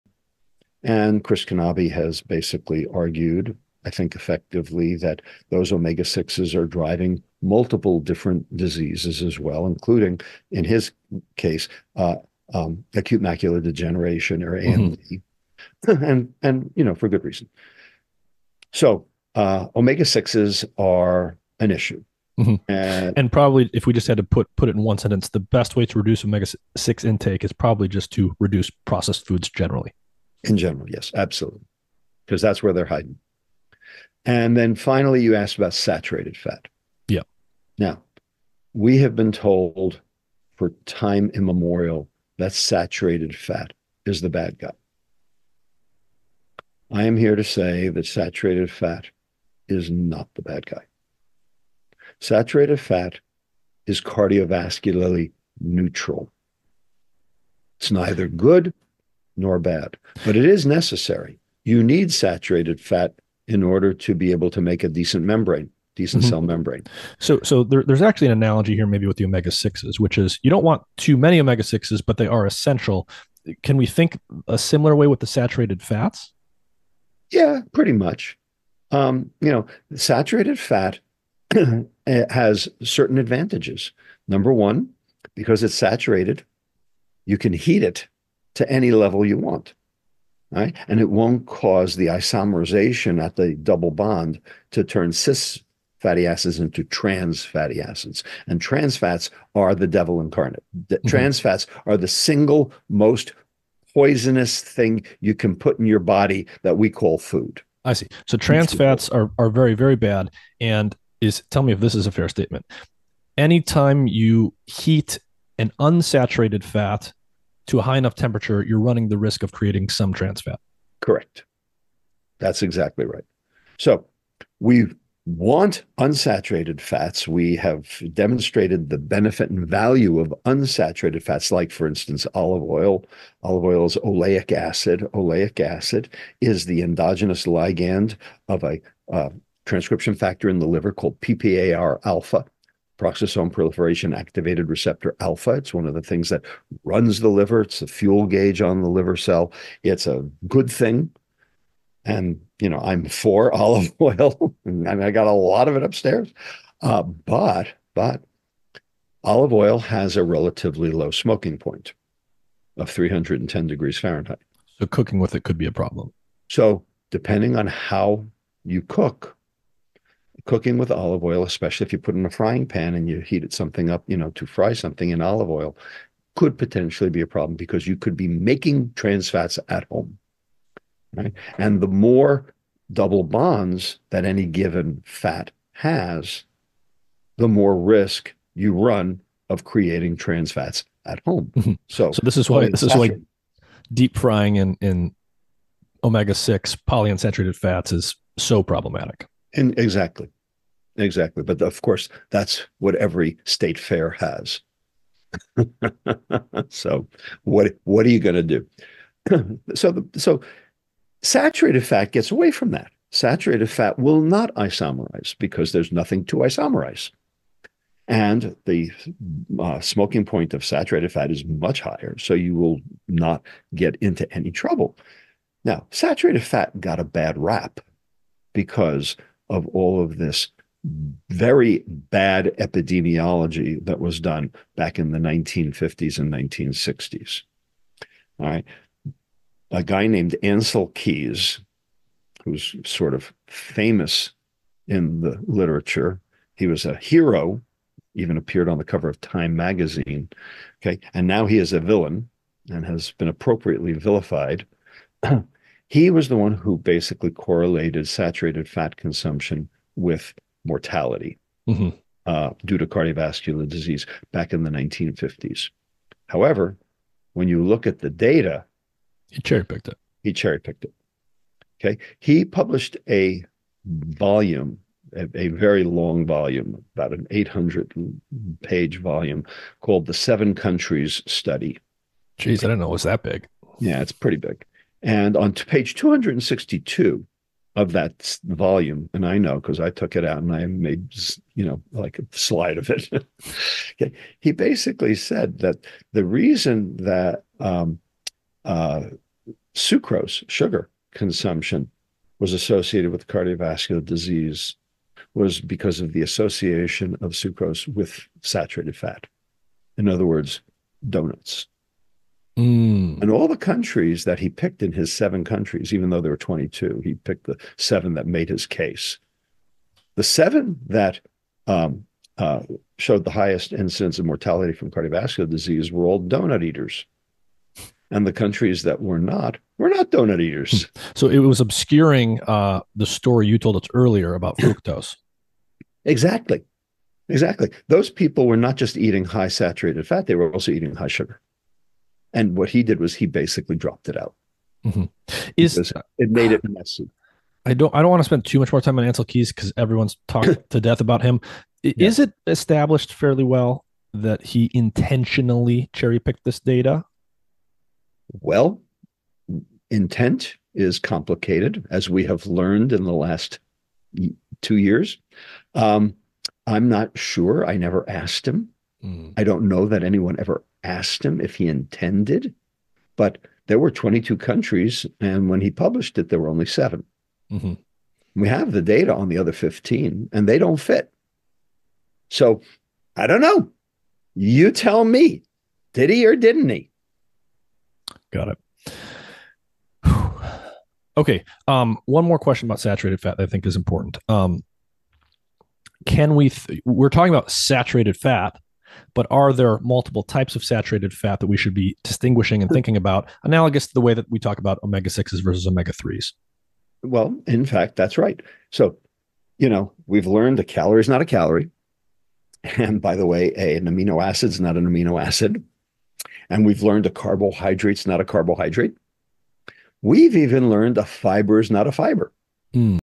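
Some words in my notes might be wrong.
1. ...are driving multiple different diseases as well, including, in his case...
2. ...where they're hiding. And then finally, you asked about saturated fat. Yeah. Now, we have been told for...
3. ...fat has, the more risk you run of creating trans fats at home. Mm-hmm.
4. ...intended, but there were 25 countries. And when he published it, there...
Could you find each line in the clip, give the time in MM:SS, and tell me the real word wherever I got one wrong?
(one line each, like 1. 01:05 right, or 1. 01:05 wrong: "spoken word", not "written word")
1. 00:06 right
2. 00:32 right
3. 03:05 right
4. 06:11 wrong: "22", not "25".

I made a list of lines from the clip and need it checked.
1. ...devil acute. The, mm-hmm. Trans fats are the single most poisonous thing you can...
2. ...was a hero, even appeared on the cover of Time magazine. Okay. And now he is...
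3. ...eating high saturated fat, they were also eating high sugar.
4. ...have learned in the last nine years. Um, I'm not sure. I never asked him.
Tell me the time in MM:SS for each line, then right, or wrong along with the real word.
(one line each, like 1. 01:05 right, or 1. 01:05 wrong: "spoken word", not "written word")
1. 01:39 wrong: "incarnate", not "acute"
2. 04:06 right
3. 05:38 right
4. 06:02 wrong: "two", not "nine".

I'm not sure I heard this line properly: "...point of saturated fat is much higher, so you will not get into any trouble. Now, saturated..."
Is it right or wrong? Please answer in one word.
right.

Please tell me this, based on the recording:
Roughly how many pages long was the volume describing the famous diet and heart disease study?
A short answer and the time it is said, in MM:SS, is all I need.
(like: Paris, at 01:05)
800, at 04:37.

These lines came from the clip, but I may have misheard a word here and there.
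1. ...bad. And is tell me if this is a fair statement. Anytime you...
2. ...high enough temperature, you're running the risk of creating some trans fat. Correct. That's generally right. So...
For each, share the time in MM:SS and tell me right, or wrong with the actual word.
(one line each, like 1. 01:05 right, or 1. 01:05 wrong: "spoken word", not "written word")
1. 01:49 right
2. 01:57 wrong: "exactly", not "generally".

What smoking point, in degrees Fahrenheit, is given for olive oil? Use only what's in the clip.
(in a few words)
310.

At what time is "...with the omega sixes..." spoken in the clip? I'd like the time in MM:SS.
01:09.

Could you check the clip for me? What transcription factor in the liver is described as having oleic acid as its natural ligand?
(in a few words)
PPAR alpha.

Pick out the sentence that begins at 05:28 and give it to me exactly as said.
And the countries that were not were not donut eaters.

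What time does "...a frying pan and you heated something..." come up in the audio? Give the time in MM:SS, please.
02:52.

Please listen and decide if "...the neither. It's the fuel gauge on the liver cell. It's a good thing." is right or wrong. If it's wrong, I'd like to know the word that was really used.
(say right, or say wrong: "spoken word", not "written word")
wrong: "liver", not "neither".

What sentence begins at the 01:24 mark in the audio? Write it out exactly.
Number one, because it's saturated, you can heat it to any level you want.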